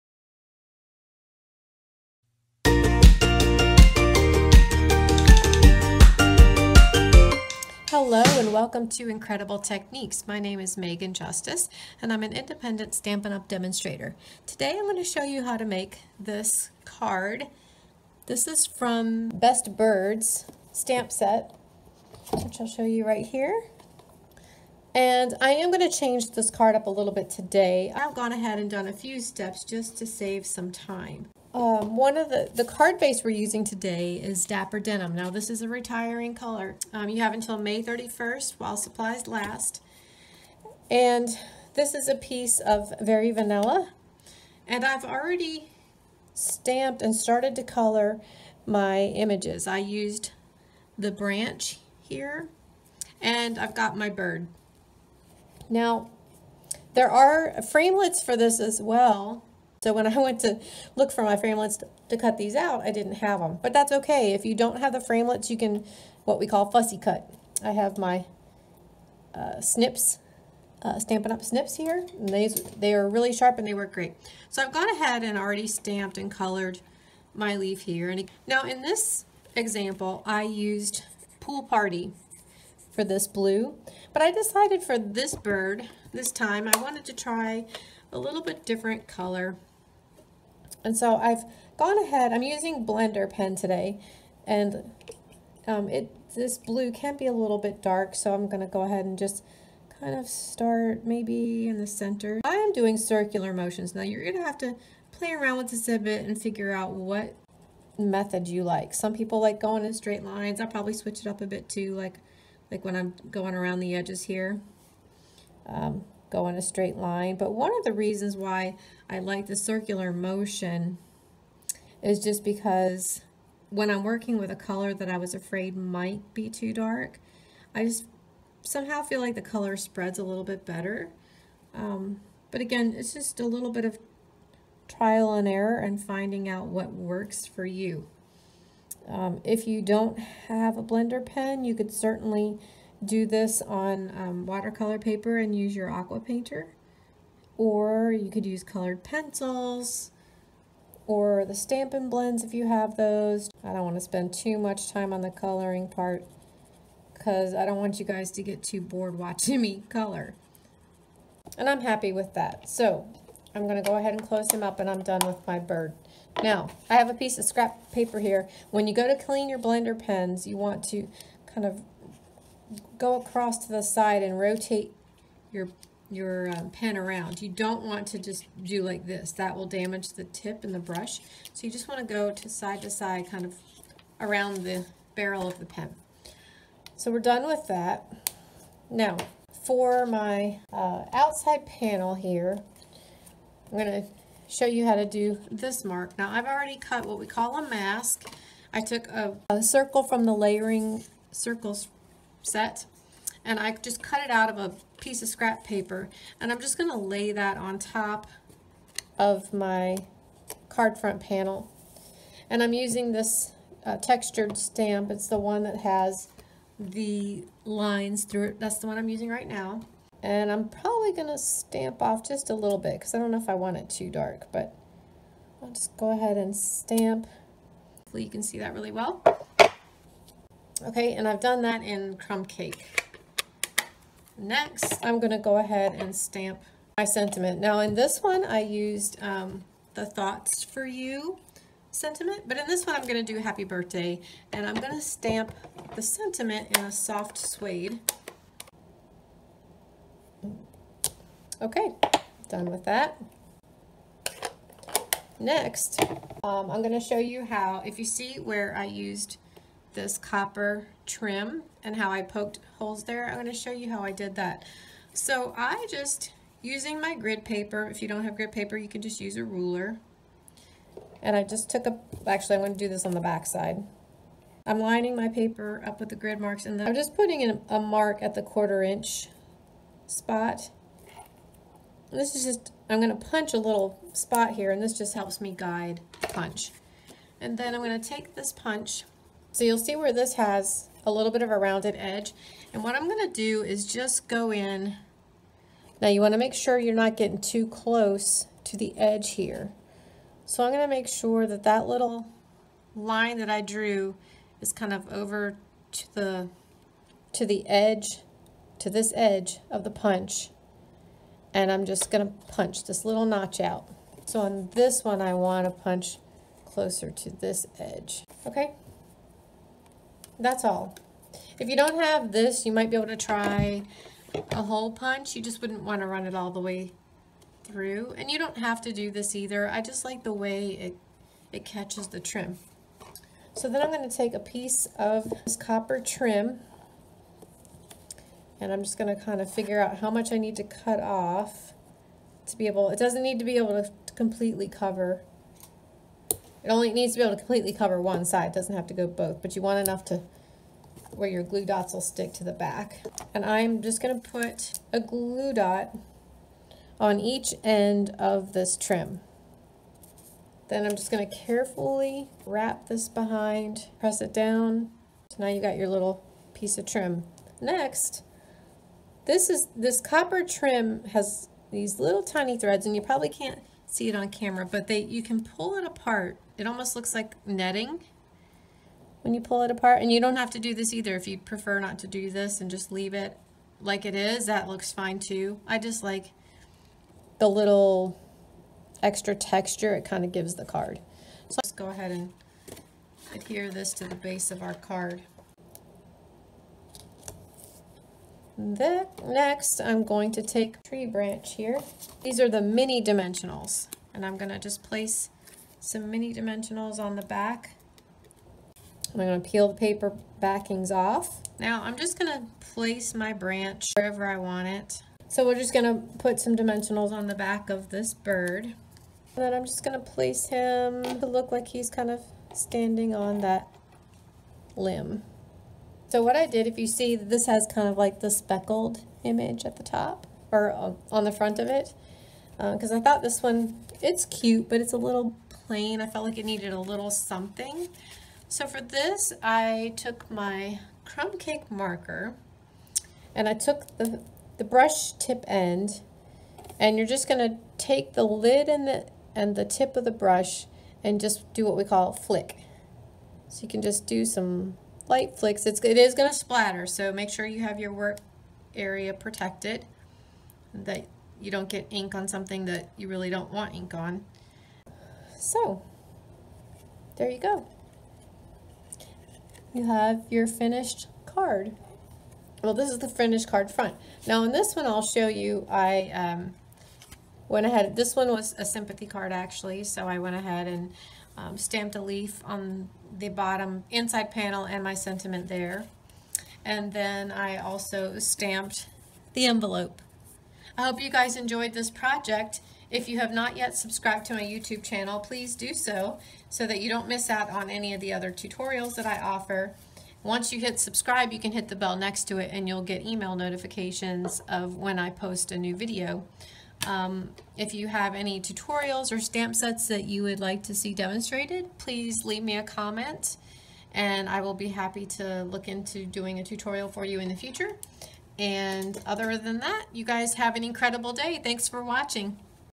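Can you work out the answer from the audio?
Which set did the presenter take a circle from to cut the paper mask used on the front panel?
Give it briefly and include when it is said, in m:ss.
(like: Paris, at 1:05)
layering circles, at 3:20.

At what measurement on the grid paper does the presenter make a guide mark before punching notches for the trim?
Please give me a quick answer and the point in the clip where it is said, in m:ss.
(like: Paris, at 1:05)
quarter inch, at 4:38.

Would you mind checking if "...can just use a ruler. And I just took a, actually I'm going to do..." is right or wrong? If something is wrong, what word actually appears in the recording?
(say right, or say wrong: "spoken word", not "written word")
right.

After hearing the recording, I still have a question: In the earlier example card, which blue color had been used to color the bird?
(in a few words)
Pool Party.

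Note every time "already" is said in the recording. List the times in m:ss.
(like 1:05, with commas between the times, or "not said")
0:45, 1:15, 3:16.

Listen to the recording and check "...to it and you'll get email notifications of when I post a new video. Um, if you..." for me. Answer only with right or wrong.
right.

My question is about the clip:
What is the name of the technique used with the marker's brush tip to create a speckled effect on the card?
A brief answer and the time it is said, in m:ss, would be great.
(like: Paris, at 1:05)
flick, at 7:32.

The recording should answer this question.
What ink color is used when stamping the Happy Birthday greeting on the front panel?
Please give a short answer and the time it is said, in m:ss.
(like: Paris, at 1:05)
soft suede, at 4:06.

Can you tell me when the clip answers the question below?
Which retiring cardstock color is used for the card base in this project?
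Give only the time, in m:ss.
0:34.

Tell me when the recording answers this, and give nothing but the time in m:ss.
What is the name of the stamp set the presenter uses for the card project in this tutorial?
0:19.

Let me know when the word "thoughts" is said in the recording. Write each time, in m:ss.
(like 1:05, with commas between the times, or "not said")
4:00, 7:12.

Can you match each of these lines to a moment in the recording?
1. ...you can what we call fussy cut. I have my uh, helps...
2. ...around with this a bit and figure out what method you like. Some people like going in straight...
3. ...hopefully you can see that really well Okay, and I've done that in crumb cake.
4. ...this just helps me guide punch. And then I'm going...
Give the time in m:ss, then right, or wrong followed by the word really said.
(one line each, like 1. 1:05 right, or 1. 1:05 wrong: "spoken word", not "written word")
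1. 1:05 wrong: "snips", not "helps"
2. 1:45 right
3. 3:47 right
4. 4:44 right.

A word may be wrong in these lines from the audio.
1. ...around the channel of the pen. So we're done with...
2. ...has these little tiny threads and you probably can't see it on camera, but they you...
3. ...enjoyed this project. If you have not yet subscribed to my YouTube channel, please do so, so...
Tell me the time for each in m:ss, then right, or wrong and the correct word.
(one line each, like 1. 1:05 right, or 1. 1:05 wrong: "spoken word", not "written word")
1. 3:04 wrong: "barrel", not "channel"
2. 6:11 right
3. 8:11 right.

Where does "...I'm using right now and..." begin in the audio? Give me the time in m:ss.
3:38.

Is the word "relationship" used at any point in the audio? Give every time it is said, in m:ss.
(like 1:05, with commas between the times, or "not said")
not said.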